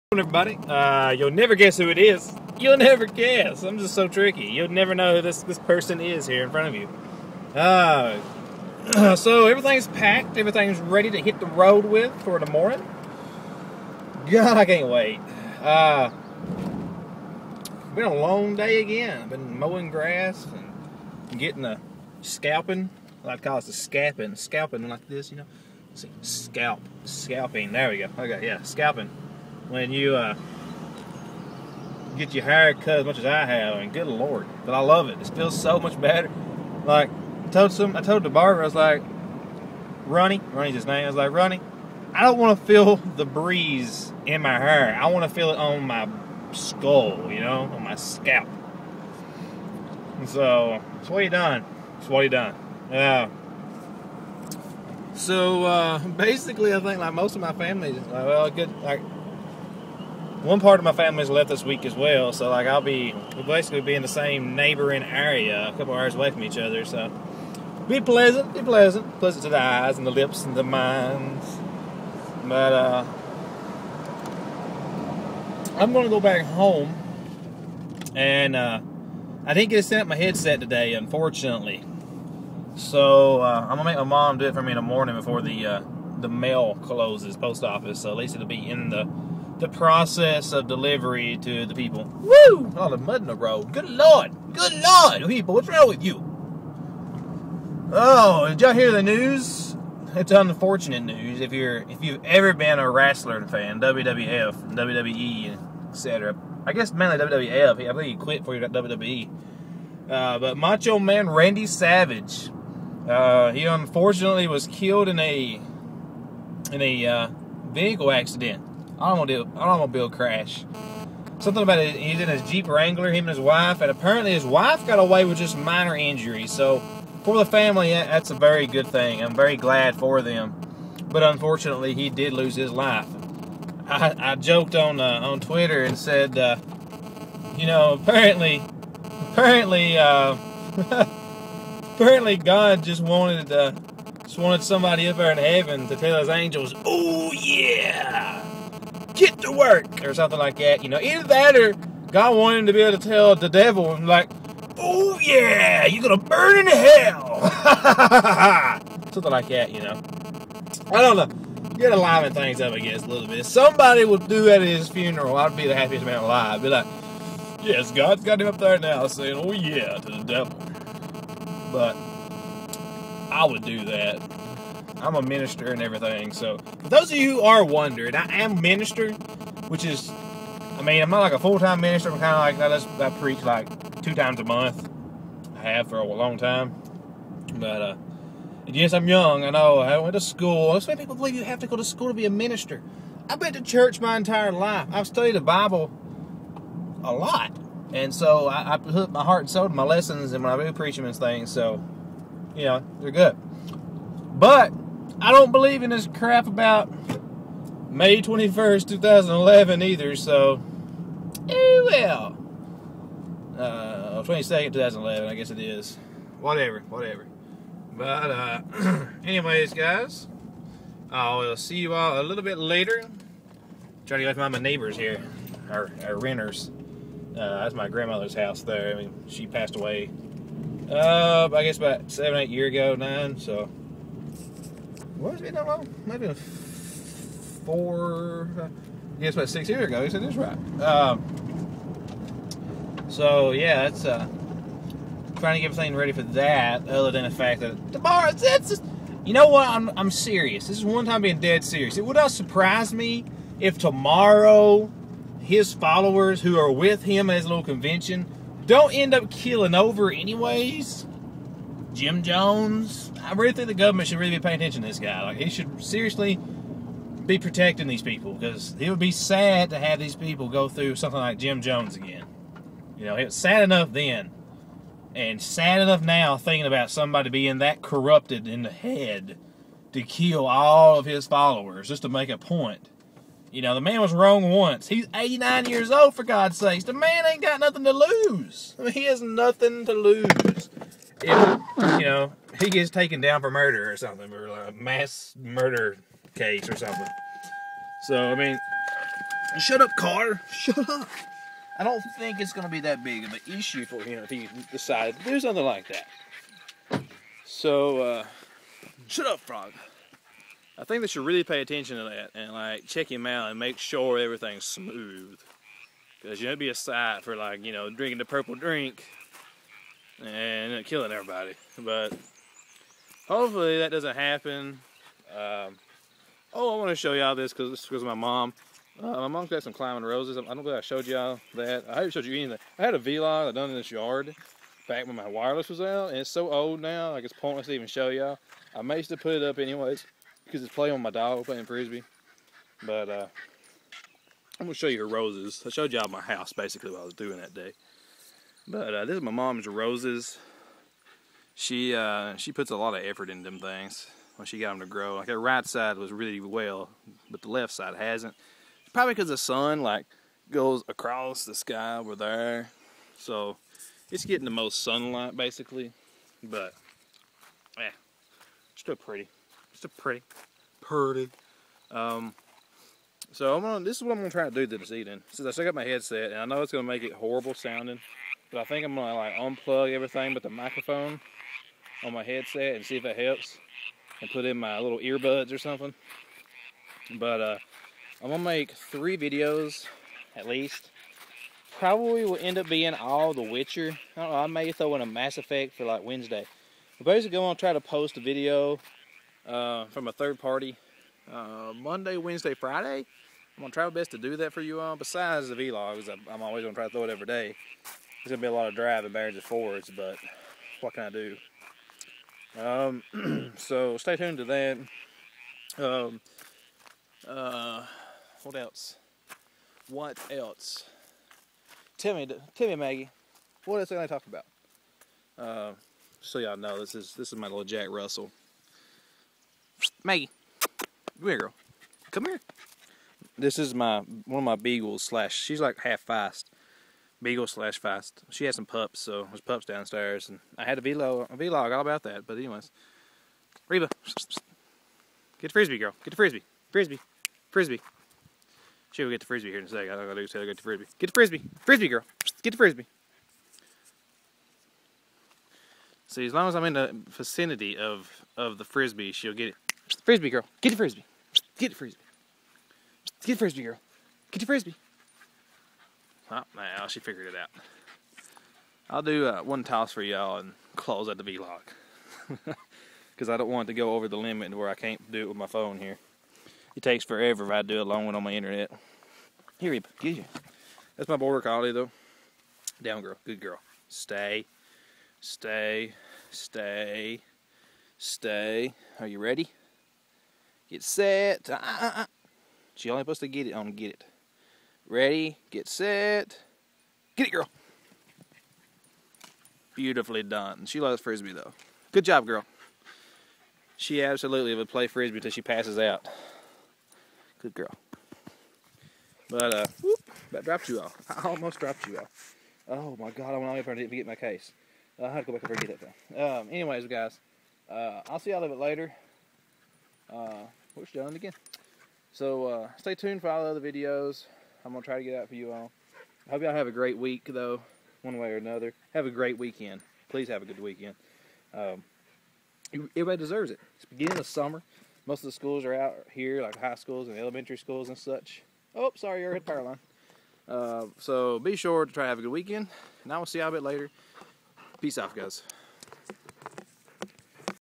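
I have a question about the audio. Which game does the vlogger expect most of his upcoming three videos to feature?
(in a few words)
The Witcher.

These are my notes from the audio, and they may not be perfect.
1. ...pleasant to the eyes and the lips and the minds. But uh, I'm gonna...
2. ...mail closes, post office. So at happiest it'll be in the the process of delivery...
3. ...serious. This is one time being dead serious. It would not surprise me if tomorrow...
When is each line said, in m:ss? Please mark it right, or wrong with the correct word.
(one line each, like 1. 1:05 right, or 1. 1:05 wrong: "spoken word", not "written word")
1. 1:09 right
2. 1:26 wrong: "least", not "happiest"
3. 4:10 right.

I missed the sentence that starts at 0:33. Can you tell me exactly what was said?
I mean, good lord, but I love it.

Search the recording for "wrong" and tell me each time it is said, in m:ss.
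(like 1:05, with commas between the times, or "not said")
1:35, 4:44.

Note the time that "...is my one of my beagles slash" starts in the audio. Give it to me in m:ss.
7:13.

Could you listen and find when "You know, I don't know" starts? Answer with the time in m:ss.
2:39.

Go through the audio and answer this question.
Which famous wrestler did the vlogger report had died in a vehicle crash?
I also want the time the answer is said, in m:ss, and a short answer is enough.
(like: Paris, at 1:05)
Randy Savage, at 1:50.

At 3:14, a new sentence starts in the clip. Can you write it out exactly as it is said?
I've studied the Bible a lot.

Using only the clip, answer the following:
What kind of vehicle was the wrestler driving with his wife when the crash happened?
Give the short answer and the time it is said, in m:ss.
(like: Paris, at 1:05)
Jeep Wrangler, at 2:02.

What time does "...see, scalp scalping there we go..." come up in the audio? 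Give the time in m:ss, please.
0:25.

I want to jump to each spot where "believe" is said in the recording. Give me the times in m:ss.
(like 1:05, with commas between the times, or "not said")
1:47, 3:11, 3:25, 5:30.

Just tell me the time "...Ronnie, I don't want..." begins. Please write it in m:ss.
0:41.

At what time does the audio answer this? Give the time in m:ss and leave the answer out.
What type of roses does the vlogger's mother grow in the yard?
5:29.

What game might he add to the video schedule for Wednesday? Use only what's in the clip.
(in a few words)
Mass Effect.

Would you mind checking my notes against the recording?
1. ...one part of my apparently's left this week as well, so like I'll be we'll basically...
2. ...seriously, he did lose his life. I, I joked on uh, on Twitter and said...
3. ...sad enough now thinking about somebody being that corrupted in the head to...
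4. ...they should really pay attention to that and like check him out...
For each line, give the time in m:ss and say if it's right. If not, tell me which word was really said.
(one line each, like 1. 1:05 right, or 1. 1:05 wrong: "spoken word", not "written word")
1. 1:00 wrong: "family", not "apparently"
2. 2:11 wrong: "unfortunately", not "seriously"
3. 4:35 right
4. 5:11 right.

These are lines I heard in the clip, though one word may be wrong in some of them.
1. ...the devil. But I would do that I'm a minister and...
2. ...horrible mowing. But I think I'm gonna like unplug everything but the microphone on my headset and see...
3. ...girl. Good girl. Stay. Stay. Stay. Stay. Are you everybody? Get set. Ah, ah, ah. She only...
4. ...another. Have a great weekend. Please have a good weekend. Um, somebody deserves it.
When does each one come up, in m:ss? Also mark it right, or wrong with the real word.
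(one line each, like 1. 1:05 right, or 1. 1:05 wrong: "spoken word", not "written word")
1. 2:50 right
2. 6:17 wrong: "sounding", not "mowing"
3. 8:03 wrong: "ready", not "everybody"
4. 8:48 wrong: "everybody", not "somebody".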